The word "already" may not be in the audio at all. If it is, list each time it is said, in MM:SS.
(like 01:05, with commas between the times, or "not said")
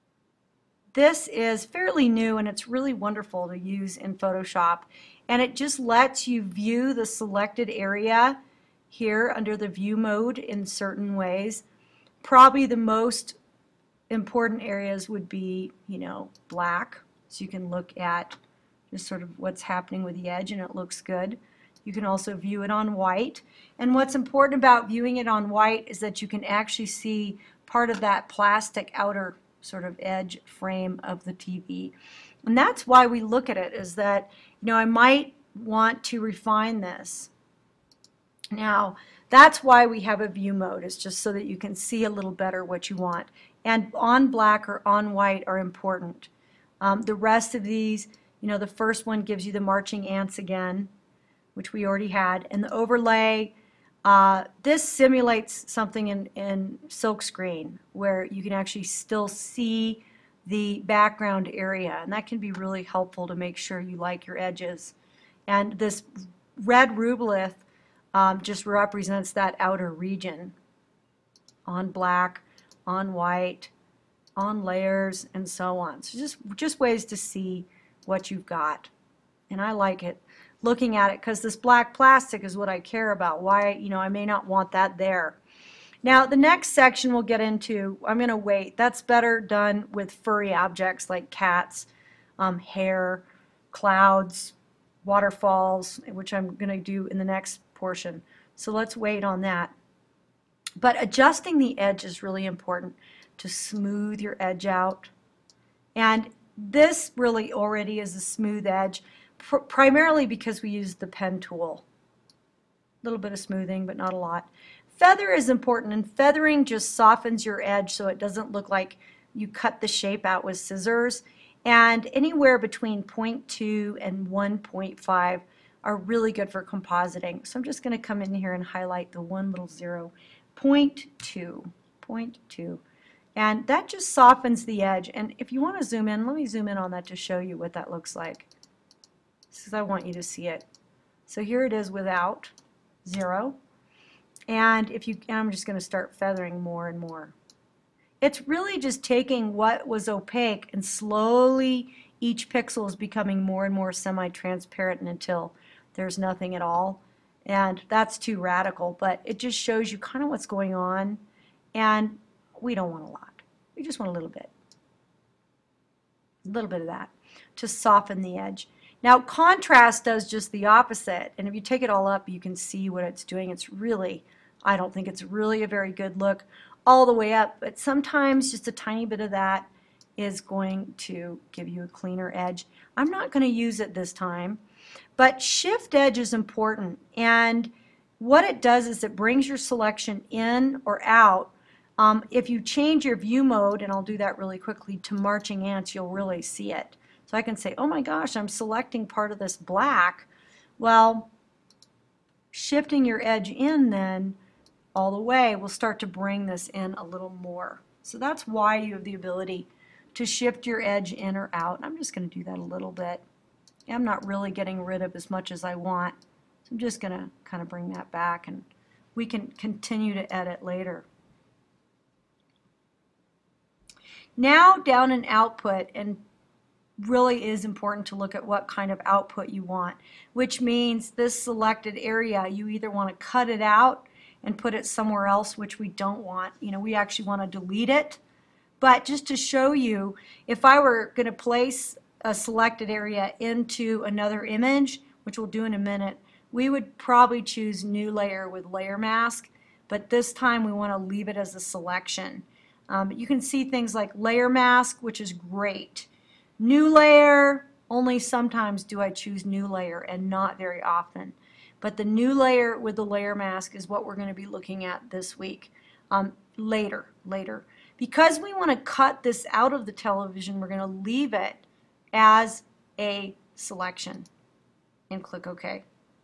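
00:51, 01:47.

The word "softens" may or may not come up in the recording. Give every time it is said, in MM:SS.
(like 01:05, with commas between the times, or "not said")
01:56, 02:14, 02:47.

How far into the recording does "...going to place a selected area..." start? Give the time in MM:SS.
04:01.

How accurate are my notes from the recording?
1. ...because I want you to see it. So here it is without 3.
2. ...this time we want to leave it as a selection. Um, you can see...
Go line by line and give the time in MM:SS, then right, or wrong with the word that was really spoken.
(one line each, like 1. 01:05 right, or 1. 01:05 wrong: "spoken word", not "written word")
1. 02:19 wrong: "0", not "3"
2. 04:10 right.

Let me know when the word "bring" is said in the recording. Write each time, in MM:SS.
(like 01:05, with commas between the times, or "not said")
03:09, 03:26, 03:37.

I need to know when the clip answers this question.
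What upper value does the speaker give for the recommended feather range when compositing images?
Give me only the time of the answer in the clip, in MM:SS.
02:04.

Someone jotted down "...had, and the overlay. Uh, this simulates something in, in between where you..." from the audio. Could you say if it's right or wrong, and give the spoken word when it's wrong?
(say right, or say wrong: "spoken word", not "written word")
wrong: "silkscreen", not "between".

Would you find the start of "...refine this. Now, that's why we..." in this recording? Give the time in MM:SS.
00:36.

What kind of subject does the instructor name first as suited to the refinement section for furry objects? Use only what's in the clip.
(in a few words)
cats.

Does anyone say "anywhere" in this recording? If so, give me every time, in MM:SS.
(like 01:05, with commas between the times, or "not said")
02:02.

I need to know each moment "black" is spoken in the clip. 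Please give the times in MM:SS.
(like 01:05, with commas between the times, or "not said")
00:16, 00:44, 01:11, 01:21, 03:19.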